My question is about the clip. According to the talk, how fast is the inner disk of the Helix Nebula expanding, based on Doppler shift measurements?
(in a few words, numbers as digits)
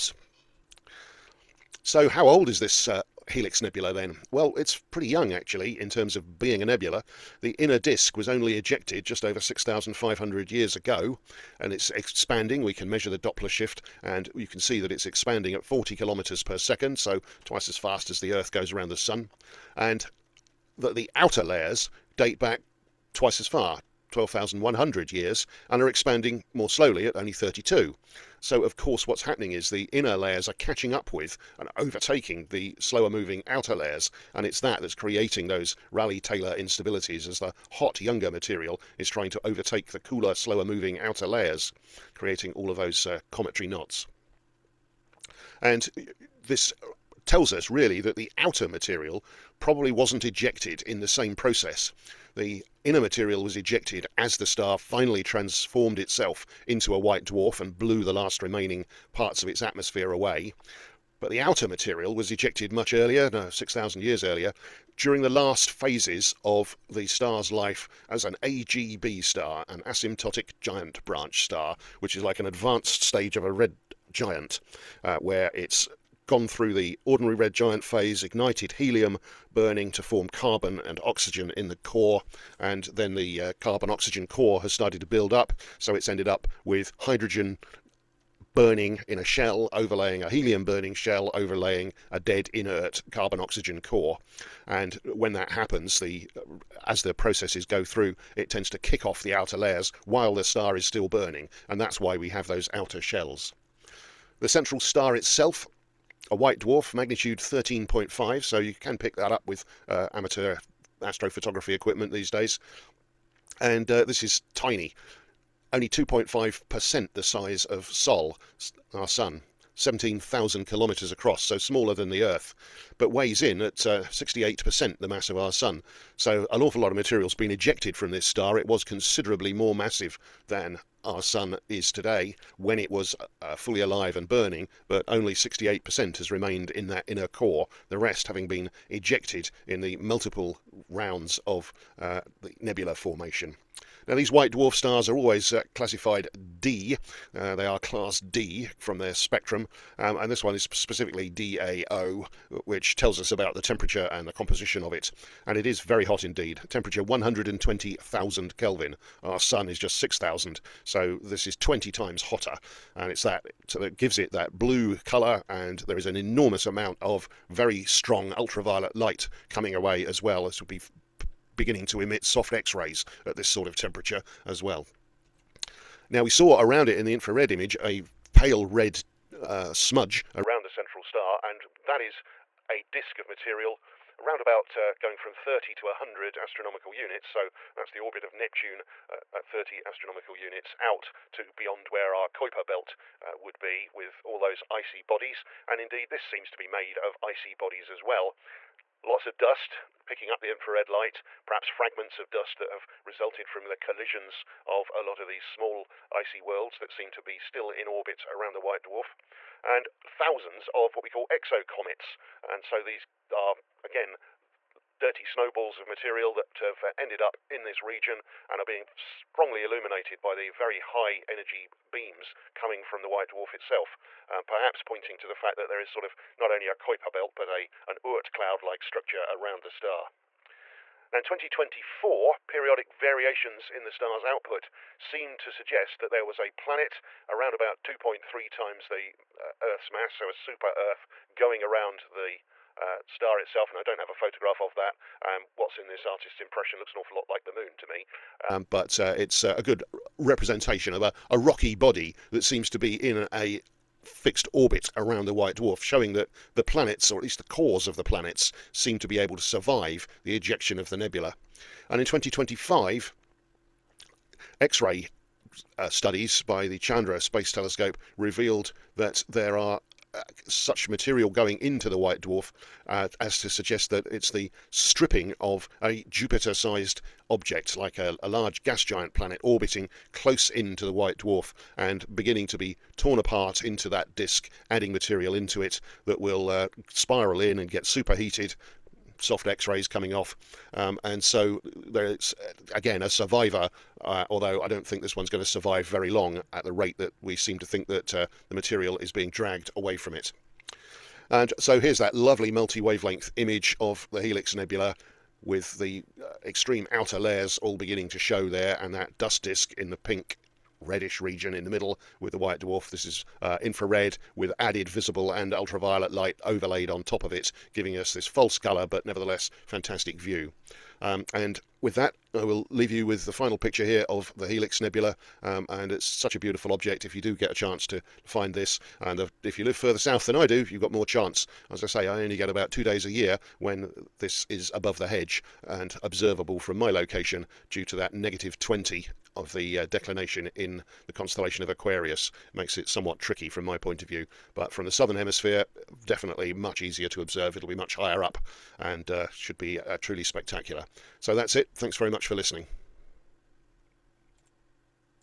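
40 kilometers per second.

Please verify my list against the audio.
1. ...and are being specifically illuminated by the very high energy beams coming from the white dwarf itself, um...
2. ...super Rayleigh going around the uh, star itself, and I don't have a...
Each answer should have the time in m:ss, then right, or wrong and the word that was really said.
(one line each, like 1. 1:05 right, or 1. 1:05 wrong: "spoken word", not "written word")
1. 3:38 wrong: "strongly", not "specifically"
2. 4:00 wrong: "Earth", not "Rayleigh".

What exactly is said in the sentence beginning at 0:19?
And that the outer layers date back twice as far, 12,100 years, and are expanding more slowly at only 32.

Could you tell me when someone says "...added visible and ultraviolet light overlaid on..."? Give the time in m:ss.
5:14.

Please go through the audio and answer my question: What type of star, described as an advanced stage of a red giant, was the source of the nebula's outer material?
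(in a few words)
asymptotic giant branch star.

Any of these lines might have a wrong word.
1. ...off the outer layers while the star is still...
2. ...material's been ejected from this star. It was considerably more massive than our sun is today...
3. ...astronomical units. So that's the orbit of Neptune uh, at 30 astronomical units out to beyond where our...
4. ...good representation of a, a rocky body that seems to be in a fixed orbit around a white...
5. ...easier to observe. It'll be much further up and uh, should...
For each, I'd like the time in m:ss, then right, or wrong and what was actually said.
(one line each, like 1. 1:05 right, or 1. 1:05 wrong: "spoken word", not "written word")
1. 1:39 right
2. 2:06 right
3. 3:06 right
4. 4:09 right
5. 5:46 wrong: "higher", not "further".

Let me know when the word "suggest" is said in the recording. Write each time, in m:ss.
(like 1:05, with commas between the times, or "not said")
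3:55, 4:33.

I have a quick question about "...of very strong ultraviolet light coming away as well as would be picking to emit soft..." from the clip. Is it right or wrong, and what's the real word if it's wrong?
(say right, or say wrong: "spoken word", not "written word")
wrong: "beginning", not "picking".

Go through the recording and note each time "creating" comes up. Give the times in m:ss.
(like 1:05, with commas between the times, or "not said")
0:34, 0:42.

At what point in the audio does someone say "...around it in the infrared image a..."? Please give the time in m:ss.
2:56.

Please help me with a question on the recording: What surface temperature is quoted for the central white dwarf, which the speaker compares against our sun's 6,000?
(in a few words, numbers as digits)
120,000 Kelvin.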